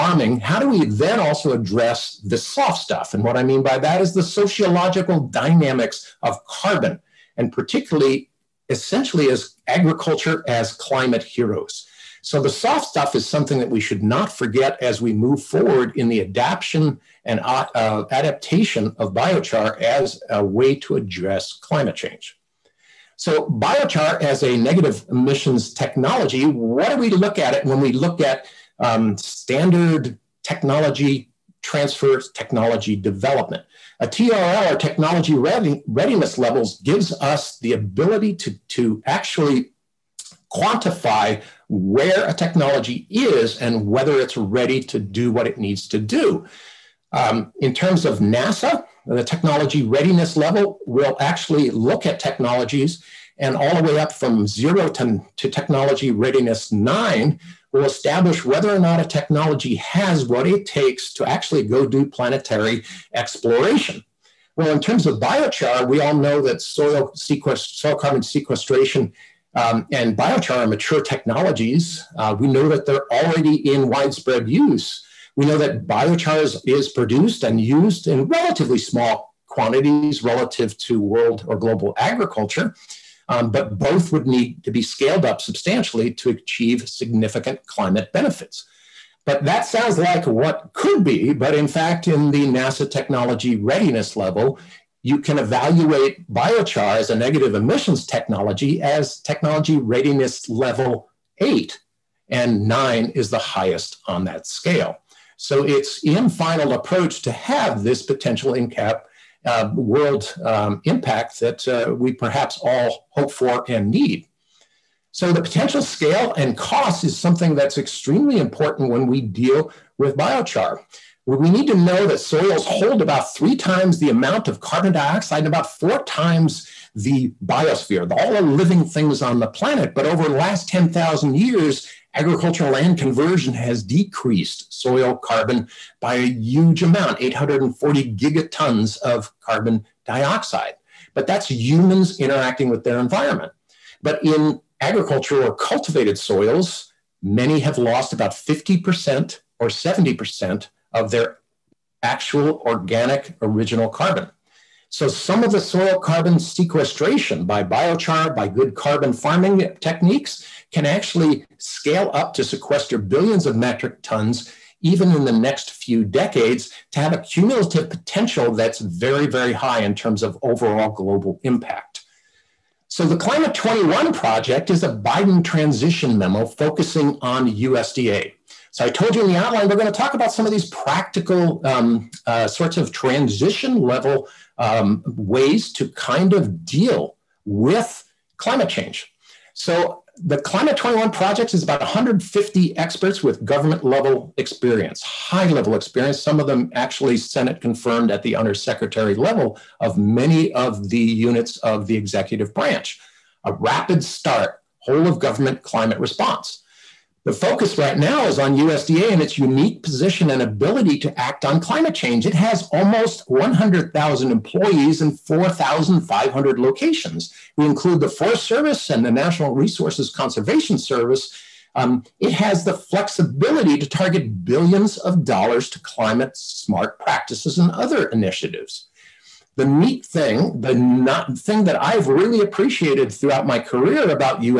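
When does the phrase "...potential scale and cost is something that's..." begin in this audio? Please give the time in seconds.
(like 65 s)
115 s.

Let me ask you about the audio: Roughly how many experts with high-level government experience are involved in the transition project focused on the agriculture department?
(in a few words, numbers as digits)
150.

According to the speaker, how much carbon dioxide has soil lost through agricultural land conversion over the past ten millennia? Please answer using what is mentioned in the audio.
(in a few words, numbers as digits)
840 gigatons.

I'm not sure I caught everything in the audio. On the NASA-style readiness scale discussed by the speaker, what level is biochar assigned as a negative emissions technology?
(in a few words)
8.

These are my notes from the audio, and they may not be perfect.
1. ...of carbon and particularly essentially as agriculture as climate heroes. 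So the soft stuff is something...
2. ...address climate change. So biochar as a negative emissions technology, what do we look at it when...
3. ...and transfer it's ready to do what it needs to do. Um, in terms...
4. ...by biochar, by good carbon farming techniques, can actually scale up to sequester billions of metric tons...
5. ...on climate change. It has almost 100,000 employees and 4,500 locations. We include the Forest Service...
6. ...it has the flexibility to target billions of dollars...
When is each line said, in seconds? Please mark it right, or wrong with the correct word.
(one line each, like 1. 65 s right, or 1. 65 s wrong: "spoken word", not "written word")
1. 6 s right
2. 20 s right
3. 43 s wrong: "whether", not "transfer"
4. 157 s right
5. 211 s right
6. 222 s right.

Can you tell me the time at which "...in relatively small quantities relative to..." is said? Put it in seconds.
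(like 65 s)
78 s.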